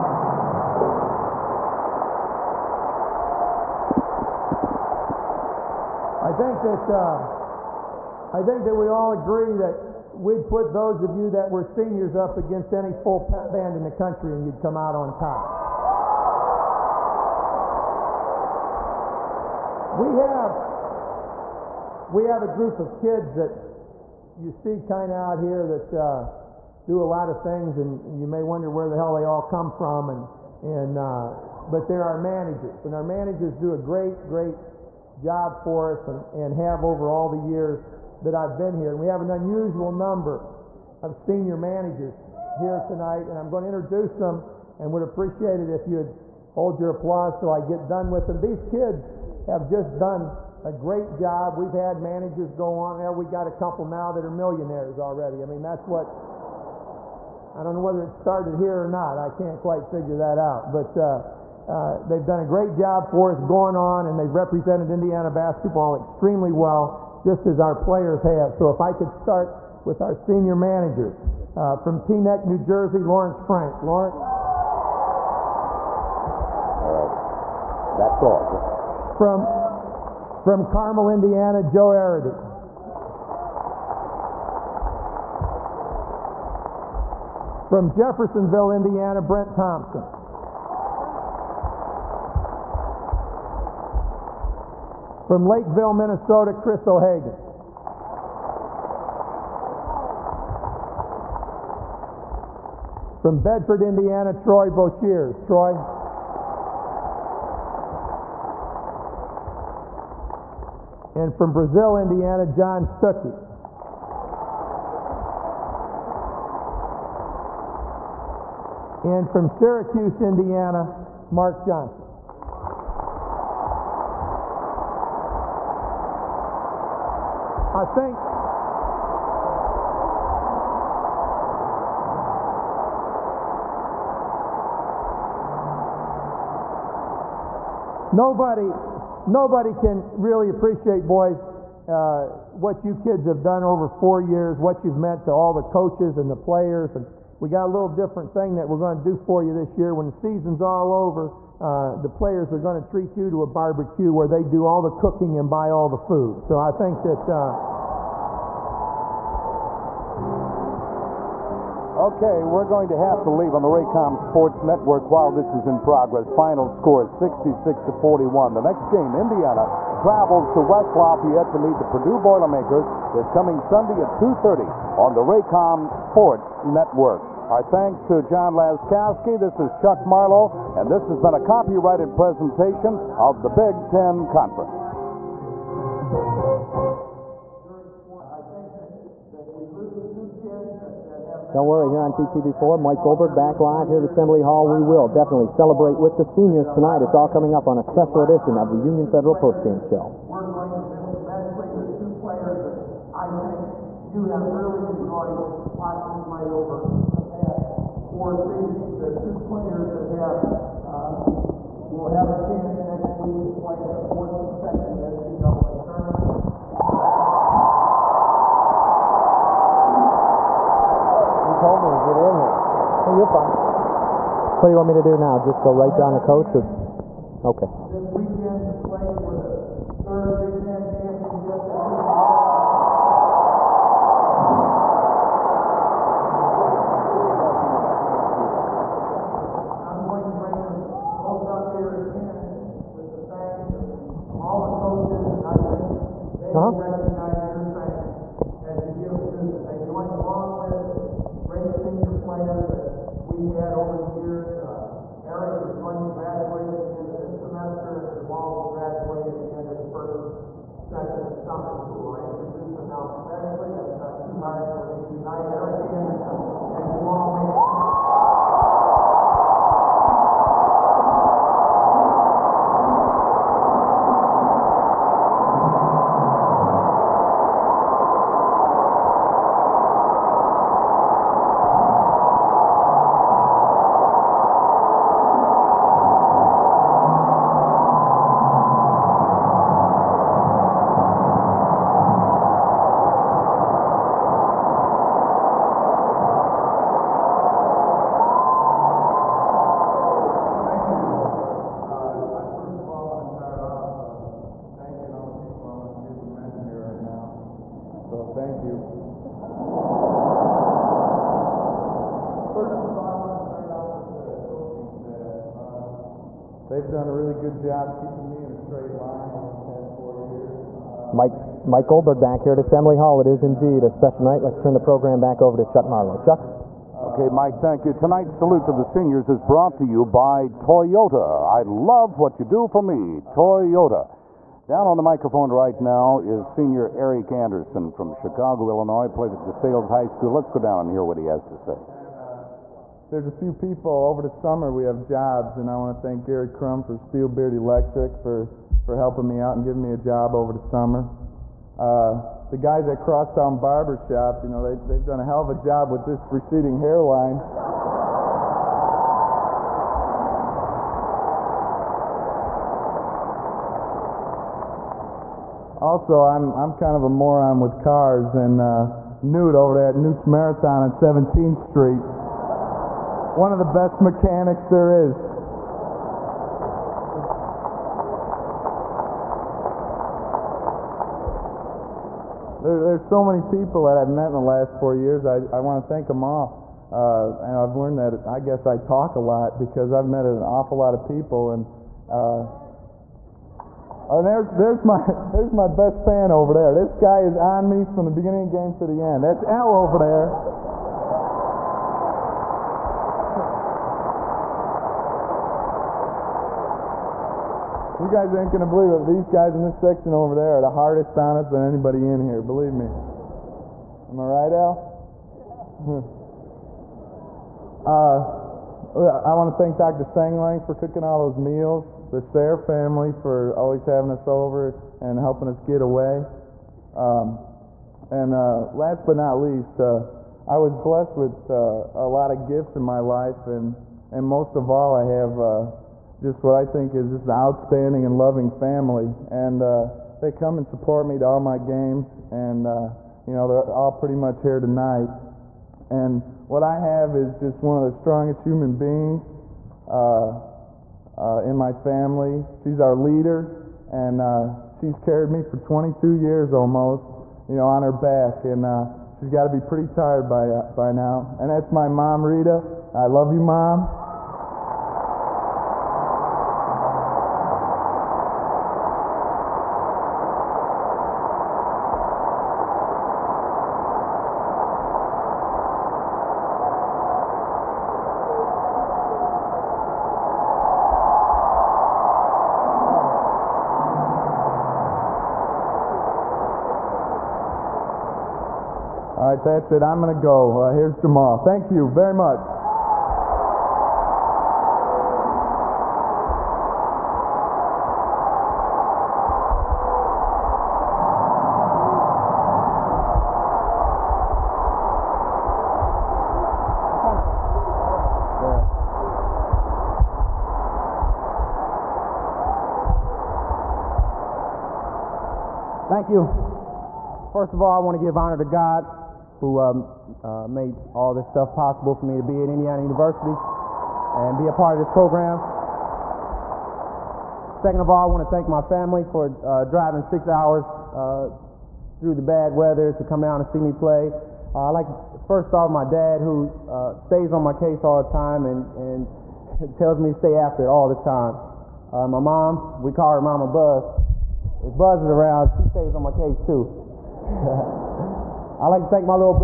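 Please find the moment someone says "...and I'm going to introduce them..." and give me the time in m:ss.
0:43.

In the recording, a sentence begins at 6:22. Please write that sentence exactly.
There, there's so many people that I've met in the last four years.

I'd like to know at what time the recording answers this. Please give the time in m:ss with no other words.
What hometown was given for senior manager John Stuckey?
1:51.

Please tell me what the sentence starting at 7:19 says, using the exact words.
And uh, they come and support me to all my games, and uh, you know they're all pretty much here tonight.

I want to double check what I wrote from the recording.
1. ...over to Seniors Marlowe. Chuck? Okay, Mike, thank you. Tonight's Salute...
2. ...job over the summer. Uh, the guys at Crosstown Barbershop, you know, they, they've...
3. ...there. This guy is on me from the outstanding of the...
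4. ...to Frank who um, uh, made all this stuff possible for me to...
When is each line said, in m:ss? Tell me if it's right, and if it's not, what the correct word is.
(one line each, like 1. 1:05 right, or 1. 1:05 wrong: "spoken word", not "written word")
1. 5:25 wrong: "Chuck", not "Seniors"
2. 5:49 right
3. 6:36 wrong: "beginning", not "outstanding"
4. 8:38 wrong: "God", not "Frank".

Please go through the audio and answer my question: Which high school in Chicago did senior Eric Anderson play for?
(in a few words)
DeSales High School.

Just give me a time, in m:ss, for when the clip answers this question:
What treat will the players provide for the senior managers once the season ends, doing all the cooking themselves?
2:33.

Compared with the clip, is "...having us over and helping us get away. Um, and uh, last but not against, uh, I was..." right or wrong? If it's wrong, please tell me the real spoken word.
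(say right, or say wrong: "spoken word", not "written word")
wrong: "least", not "against".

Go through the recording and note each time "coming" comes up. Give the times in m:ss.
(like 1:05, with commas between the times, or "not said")
2:53, 3:17.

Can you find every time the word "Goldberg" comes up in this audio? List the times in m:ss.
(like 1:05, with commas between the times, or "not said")
3:13, 5:21.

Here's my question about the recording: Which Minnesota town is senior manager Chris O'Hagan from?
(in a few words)
Lakeville.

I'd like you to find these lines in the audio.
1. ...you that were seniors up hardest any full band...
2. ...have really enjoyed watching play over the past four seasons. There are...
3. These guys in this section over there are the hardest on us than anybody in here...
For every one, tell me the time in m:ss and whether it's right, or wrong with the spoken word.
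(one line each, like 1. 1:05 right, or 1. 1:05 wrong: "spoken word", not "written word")
1. 0:11 wrong: "against", not "hardest"
2. 3:24 right
3. 6:49 right.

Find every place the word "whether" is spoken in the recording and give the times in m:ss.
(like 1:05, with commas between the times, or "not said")
0:57.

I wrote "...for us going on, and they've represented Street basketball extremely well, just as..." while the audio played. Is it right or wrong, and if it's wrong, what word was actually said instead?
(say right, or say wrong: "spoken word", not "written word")
wrong: "Indiana", not "Street".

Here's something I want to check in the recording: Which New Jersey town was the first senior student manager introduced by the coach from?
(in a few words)
Teaneck.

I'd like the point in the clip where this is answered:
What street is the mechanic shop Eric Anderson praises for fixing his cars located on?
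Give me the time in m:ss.
6:10.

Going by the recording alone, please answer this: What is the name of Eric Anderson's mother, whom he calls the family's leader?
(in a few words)
Rita.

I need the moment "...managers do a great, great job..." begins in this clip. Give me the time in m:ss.
0:33.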